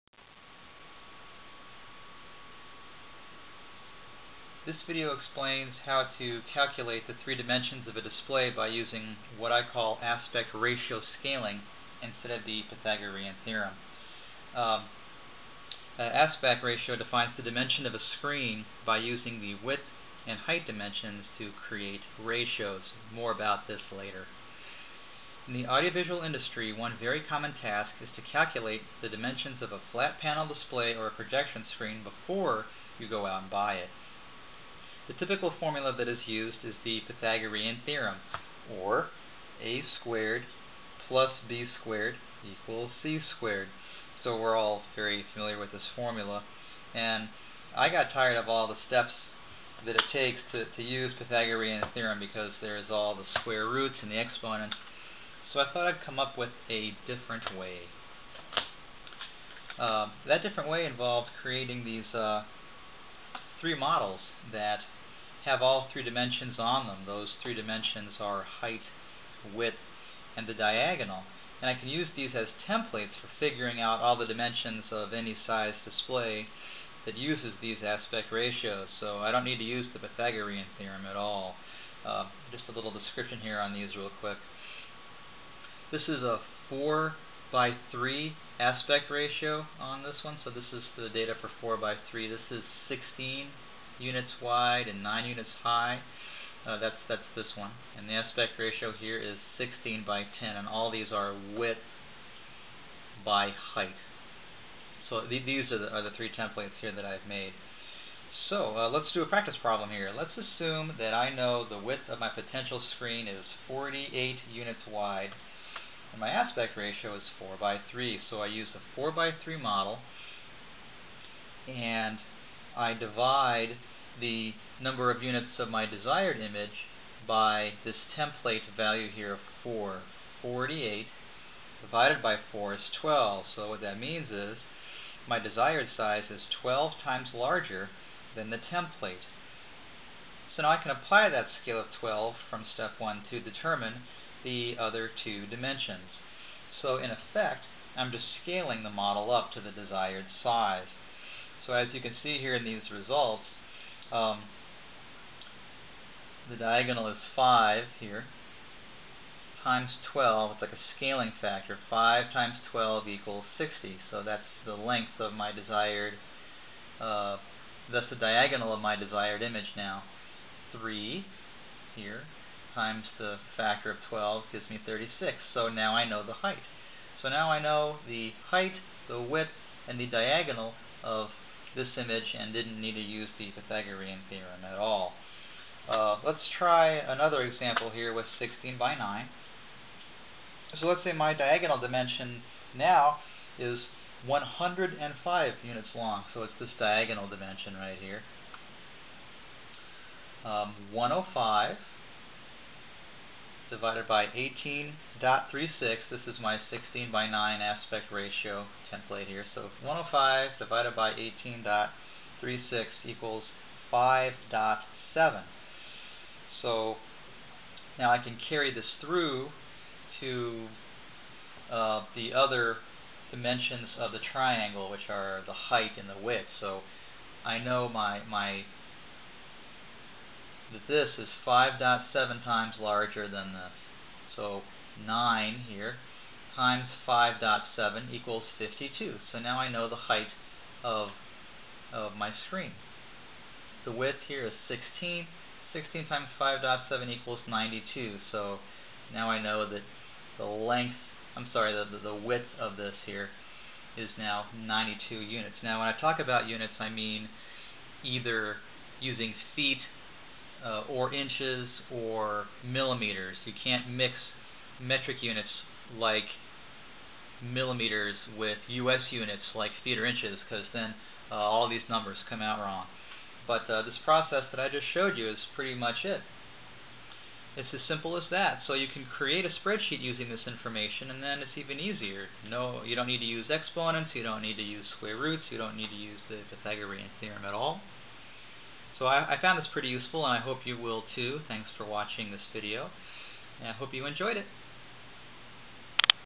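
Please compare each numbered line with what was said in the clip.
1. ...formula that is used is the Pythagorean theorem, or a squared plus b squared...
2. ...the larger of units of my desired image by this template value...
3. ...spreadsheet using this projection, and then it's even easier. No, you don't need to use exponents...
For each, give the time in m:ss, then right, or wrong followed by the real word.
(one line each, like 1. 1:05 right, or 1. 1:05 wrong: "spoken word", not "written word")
1. 0:35 right
2. 2:04 wrong: "number", not "larger"
3. 4:39 wrong: "information", not "projection".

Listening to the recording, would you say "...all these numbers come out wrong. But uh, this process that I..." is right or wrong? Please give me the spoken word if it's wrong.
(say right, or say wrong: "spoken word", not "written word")
right.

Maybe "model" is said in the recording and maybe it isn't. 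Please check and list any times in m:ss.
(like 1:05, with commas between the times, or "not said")
1:03, 1:59, 2:28.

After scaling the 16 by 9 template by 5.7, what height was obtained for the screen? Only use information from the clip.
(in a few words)
52.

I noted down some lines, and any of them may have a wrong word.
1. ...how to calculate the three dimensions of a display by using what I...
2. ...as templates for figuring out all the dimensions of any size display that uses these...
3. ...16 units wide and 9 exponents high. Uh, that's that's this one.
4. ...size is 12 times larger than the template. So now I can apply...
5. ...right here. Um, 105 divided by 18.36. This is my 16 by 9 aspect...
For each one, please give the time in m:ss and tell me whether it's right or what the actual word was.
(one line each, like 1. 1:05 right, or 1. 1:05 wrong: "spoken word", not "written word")
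1. 0:05 right
2. 1:12 right
3. 1:32 wrong: "units", not "exponents"
4. 2:15 right
5. 3:17 right.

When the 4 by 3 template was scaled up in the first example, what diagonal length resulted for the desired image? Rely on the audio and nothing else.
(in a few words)
60.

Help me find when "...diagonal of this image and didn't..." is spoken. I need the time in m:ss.
3:00.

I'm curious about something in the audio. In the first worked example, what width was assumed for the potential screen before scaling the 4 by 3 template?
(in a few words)
48 units.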